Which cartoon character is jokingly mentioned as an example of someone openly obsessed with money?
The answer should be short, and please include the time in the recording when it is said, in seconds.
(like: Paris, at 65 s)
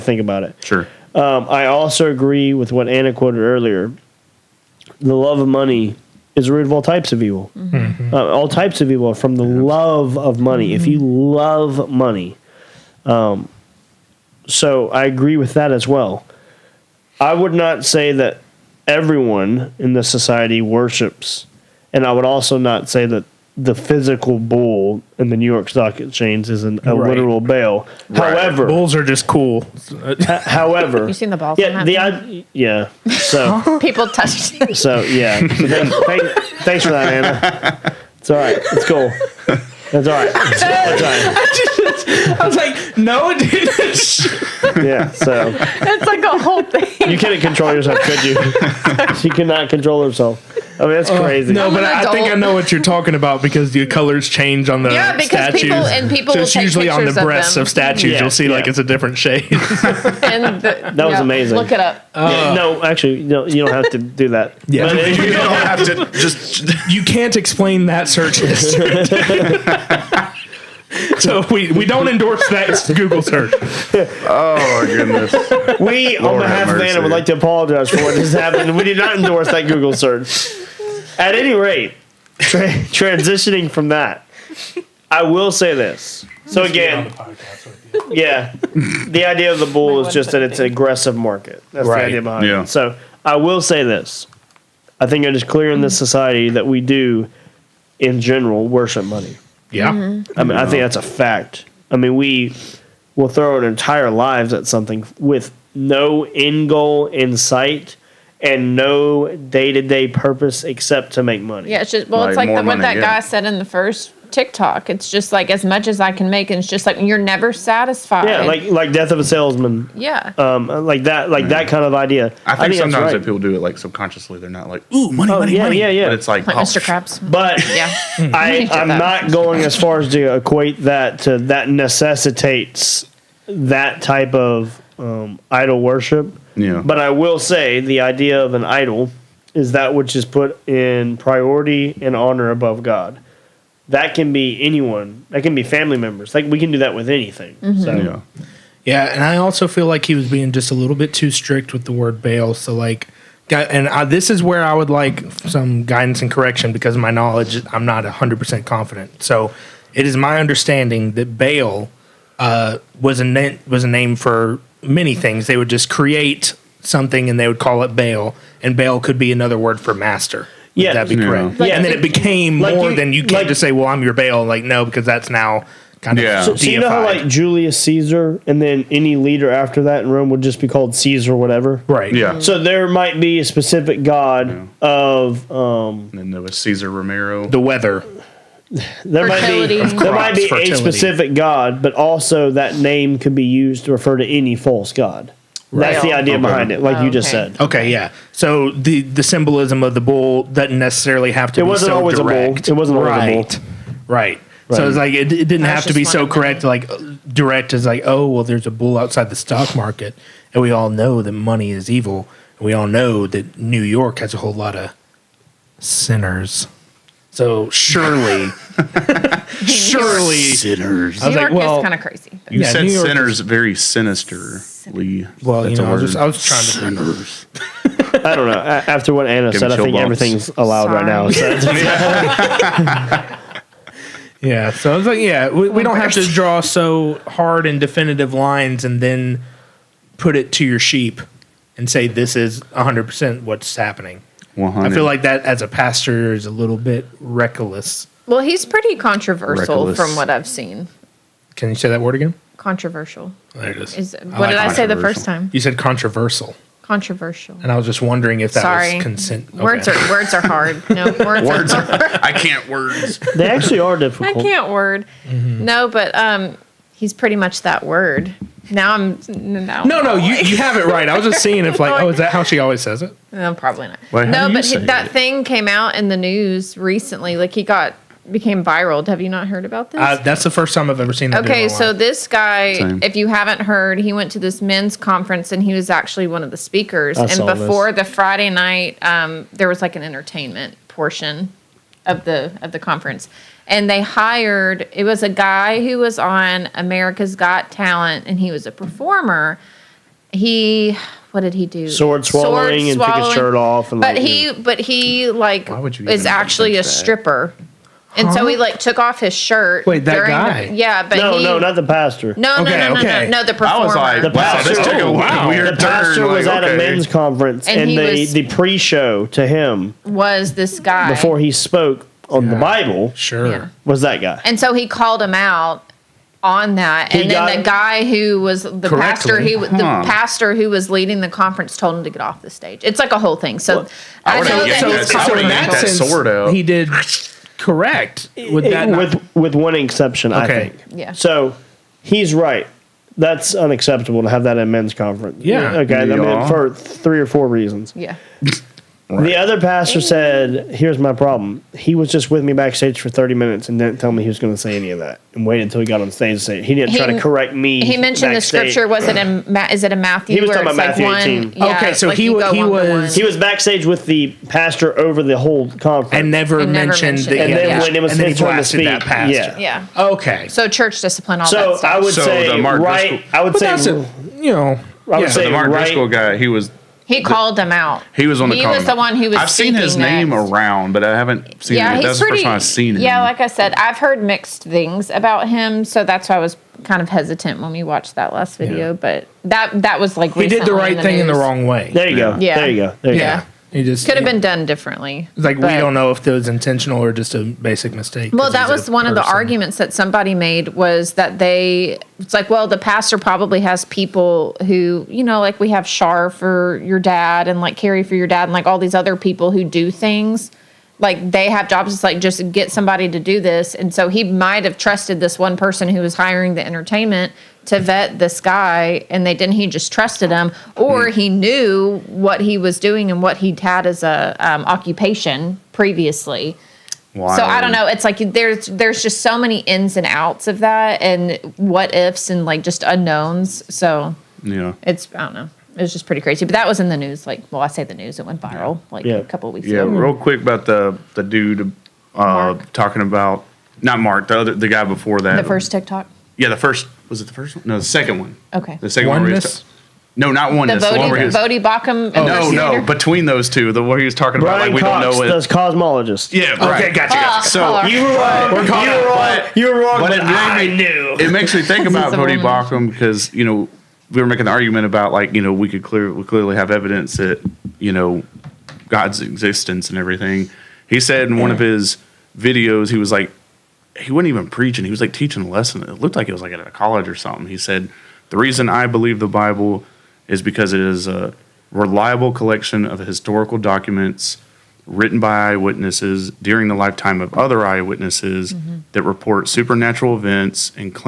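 Mr. Krabs, at 126 s.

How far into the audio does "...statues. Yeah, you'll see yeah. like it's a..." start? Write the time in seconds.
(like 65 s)
57 s.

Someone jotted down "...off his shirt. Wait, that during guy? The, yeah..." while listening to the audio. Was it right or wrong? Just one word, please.
right.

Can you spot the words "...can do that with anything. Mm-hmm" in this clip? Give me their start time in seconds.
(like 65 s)
146 s.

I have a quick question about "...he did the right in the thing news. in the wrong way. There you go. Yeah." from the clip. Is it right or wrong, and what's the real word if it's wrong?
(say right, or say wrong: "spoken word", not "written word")
right.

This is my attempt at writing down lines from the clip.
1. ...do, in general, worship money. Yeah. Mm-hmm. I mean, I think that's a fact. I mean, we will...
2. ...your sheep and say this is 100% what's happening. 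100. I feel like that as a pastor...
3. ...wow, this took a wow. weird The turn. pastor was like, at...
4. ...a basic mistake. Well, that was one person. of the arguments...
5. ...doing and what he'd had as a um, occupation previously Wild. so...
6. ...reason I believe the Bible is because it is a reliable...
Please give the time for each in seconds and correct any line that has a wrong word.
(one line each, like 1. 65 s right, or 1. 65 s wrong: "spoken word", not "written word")
1. 96 s right
2. 240 s right
3. 314 s right
4. 397 s right
5. 422 s right
6. 478 s right.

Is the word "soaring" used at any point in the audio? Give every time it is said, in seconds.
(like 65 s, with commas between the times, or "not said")
not said.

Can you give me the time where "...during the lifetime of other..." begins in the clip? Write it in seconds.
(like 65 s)
486 s.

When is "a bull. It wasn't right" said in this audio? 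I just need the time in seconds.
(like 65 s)
202 s.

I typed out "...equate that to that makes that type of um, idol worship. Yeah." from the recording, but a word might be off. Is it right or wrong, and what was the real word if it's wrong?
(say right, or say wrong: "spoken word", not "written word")
wrong: "necessitates", not "makes".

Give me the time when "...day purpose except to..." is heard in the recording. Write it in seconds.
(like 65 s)
109 s.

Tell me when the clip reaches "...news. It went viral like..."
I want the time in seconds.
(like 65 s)
437 s.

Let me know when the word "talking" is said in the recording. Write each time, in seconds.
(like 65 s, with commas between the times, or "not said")
52 s, 360 s, 442 s, 454 s.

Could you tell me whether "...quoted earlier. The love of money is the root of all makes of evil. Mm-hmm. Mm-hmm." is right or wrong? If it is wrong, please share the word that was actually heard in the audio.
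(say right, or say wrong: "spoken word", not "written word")
wrong: "types", not "makes".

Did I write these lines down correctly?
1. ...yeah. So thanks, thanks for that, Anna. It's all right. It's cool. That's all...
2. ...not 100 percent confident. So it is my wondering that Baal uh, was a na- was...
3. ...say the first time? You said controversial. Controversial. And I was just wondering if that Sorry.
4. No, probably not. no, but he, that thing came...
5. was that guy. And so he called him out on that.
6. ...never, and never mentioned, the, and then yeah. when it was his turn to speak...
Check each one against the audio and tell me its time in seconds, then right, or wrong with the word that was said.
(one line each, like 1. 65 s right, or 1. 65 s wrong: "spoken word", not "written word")
1. 34 s right
2. 157 s wrong: "understanding", not "wondering"
3. 254 s right
4. 273 s right
5. 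323 s right
6. 366 s right.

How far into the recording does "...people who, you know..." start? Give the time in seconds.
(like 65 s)
403 s.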